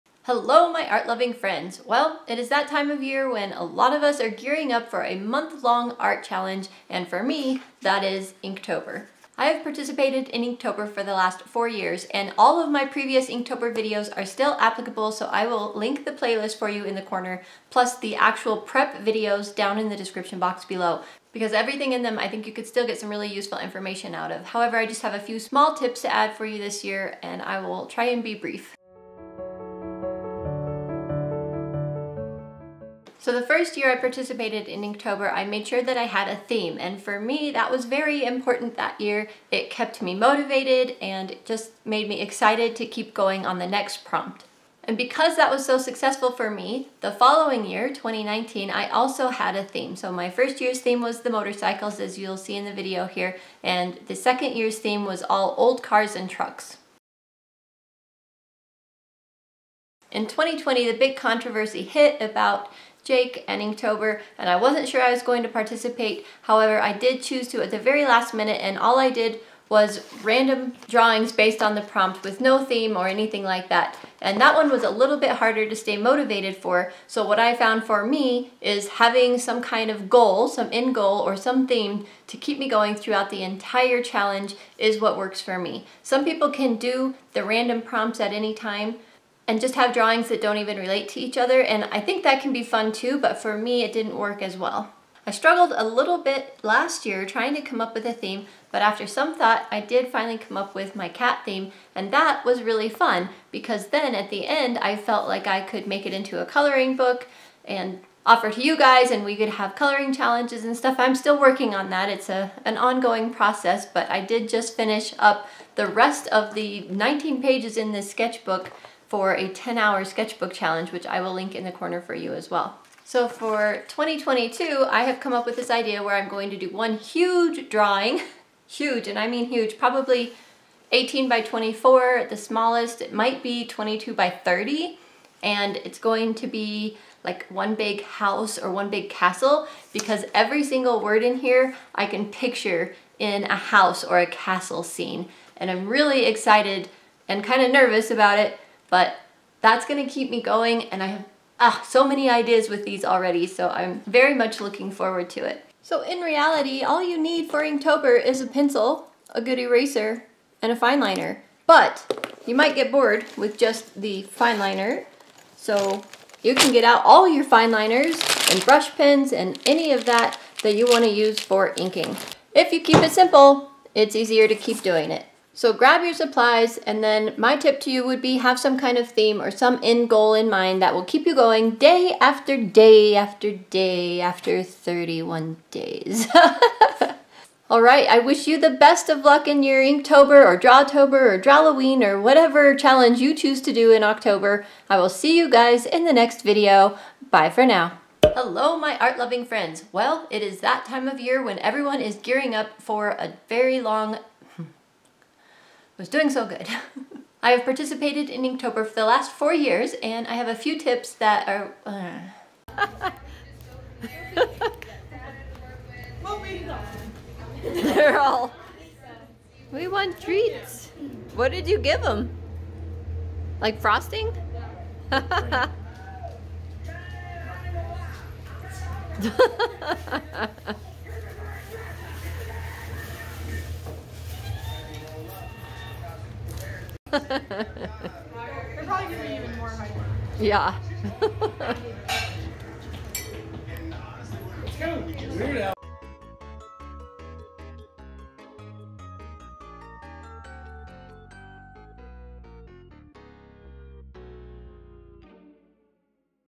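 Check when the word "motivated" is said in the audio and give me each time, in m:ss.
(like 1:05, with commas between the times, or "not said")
0:40, 1:15.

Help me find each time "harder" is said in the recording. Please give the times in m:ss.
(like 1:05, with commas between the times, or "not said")
1:15.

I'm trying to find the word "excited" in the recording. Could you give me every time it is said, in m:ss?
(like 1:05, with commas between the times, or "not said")
0:42, 2:26.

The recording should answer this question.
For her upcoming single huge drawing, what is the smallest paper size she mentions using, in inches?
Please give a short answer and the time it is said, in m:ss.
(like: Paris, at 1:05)
18 by 24, at 2:10.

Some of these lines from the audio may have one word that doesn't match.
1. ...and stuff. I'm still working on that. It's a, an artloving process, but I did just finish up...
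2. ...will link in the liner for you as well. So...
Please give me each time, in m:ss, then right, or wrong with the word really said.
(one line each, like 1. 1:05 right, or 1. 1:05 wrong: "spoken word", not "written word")
1. 1:50 wrong: "ongoing", not "artloving"
2. 2:01 wrong: "corner", not "liner".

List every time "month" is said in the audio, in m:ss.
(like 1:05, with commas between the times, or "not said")
0:05.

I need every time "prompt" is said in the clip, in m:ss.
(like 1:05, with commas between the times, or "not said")
0:44, 1:11, 1:27.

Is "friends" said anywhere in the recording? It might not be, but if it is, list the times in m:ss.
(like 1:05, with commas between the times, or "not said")
0:01, 3:19.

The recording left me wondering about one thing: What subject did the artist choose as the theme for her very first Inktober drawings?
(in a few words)
Motorcycles.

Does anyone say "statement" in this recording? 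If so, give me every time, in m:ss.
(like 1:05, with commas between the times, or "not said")
not said.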